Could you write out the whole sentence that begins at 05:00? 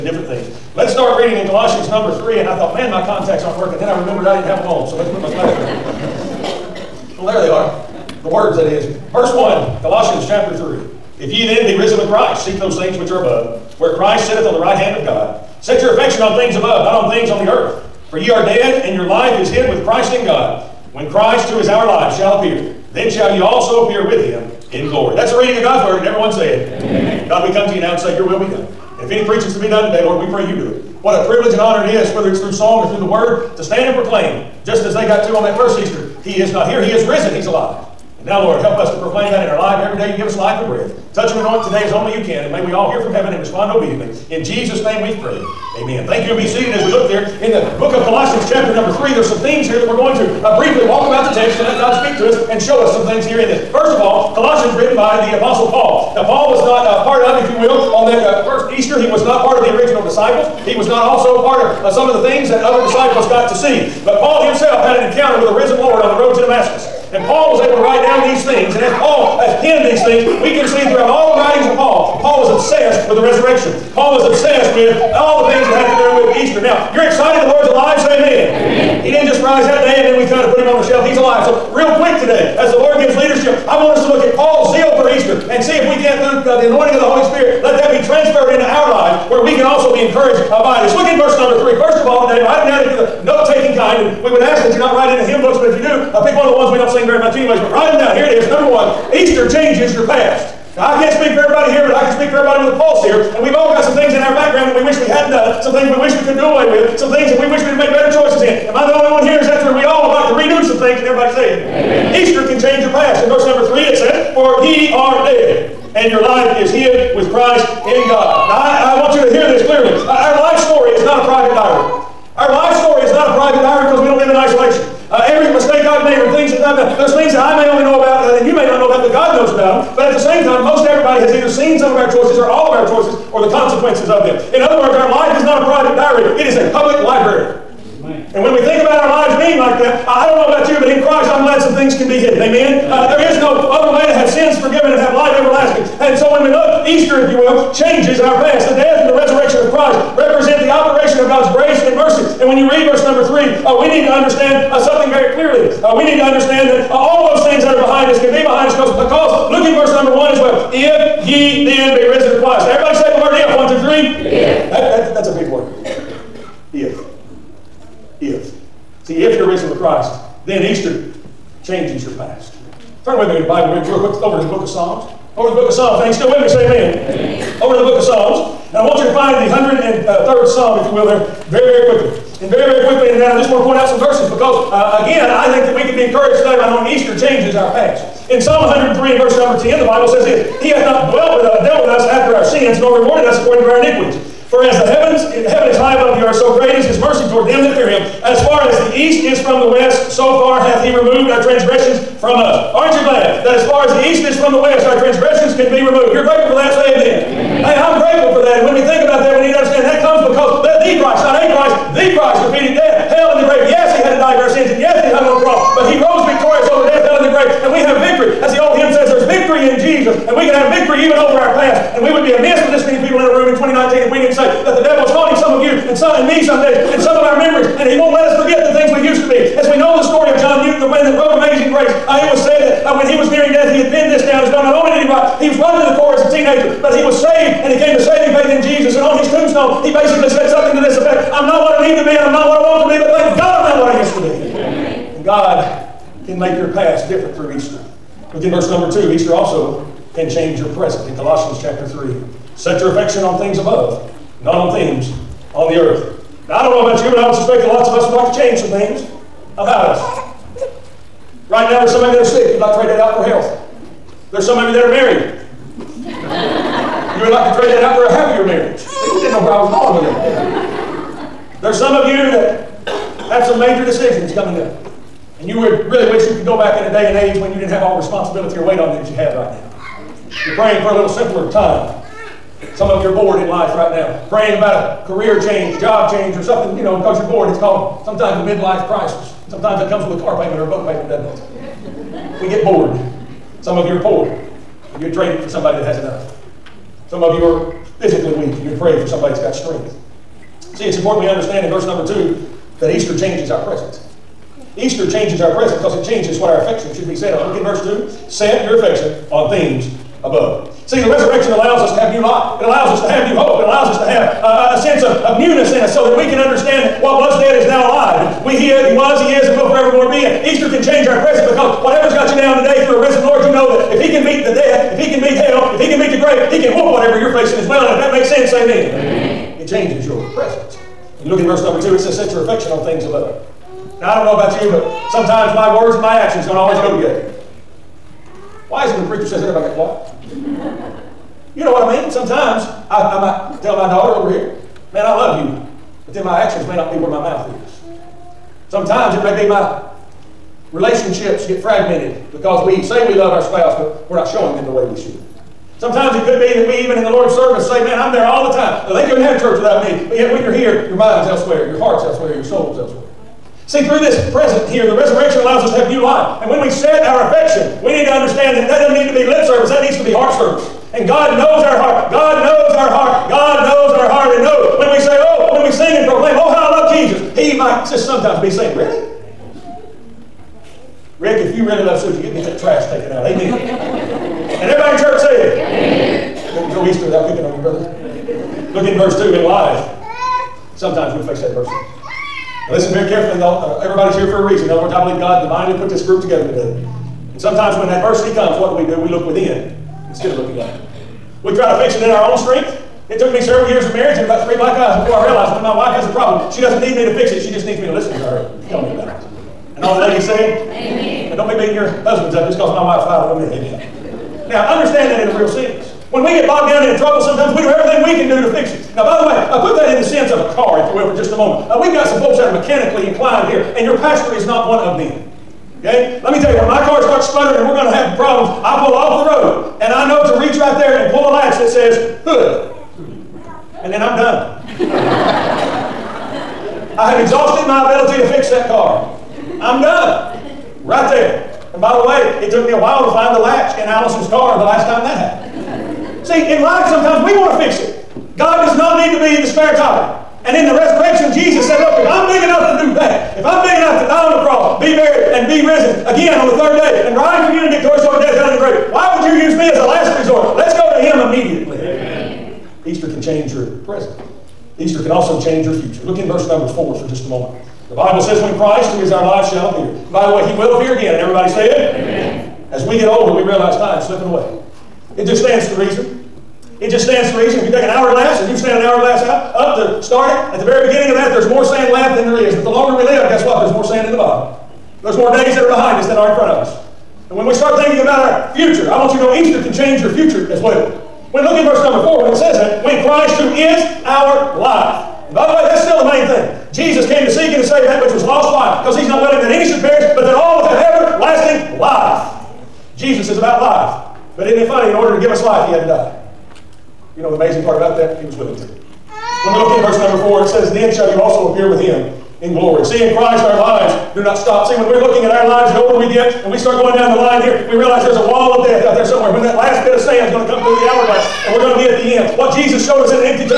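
See, it's important we understand in verse number two that Easter changes our present.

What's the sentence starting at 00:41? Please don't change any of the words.
Touch and anoint today as only you can.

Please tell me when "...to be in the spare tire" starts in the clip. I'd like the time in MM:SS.
07:29.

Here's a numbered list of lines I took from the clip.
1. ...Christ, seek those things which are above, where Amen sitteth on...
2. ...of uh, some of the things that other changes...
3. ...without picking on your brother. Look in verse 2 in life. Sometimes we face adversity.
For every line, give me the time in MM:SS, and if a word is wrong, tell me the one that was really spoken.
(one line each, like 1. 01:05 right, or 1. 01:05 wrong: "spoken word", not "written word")
1. 00:12 wrong: "Christ", not "Amen"
2. 01:01 wrong: "disciples", not "changes"
3. 06:27 right.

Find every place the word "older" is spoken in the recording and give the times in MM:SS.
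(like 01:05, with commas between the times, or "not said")
07:53, 08:35.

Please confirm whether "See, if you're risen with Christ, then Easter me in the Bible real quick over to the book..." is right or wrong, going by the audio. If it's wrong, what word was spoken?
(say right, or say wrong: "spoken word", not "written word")
right.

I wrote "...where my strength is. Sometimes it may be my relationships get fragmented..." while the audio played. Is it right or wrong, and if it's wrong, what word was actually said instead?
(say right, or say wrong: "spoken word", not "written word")
wrong: "mouth", not "strength".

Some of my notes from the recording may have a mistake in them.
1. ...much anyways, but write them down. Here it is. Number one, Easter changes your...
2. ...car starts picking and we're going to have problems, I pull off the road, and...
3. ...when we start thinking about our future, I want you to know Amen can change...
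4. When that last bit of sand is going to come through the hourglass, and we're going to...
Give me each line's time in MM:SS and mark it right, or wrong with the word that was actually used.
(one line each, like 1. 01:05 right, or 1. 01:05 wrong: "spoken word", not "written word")
1. 01:37 right
2. 07:06 wrong: "sputtering", not "picking"
3. 08:07 wrong: "Easter", not "Amen"
4. 08:39 right.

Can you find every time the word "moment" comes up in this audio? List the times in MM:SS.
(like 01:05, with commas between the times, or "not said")
07:01, 07:47.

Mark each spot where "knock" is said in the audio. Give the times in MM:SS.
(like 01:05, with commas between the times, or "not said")
not said.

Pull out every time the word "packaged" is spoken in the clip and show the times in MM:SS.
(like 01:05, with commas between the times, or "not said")
not said.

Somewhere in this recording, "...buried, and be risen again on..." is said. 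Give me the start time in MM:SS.
07:34.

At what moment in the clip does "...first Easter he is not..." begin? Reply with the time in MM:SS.
00:35.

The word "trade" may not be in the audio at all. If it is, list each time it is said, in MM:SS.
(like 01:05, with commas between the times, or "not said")
04:22, 04:27, 04:55.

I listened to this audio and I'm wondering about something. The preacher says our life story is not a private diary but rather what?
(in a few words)
a public library.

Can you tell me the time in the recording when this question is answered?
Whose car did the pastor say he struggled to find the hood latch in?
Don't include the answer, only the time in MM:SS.
07:23.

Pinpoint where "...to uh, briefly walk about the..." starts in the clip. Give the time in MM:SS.
00:50.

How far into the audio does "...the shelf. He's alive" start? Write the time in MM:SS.
01:20.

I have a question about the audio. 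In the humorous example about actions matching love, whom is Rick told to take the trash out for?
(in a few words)
Susie.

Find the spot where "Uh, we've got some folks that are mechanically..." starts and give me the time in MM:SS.
07:01.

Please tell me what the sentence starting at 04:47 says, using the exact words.
It's called sometimes a midlife crisis.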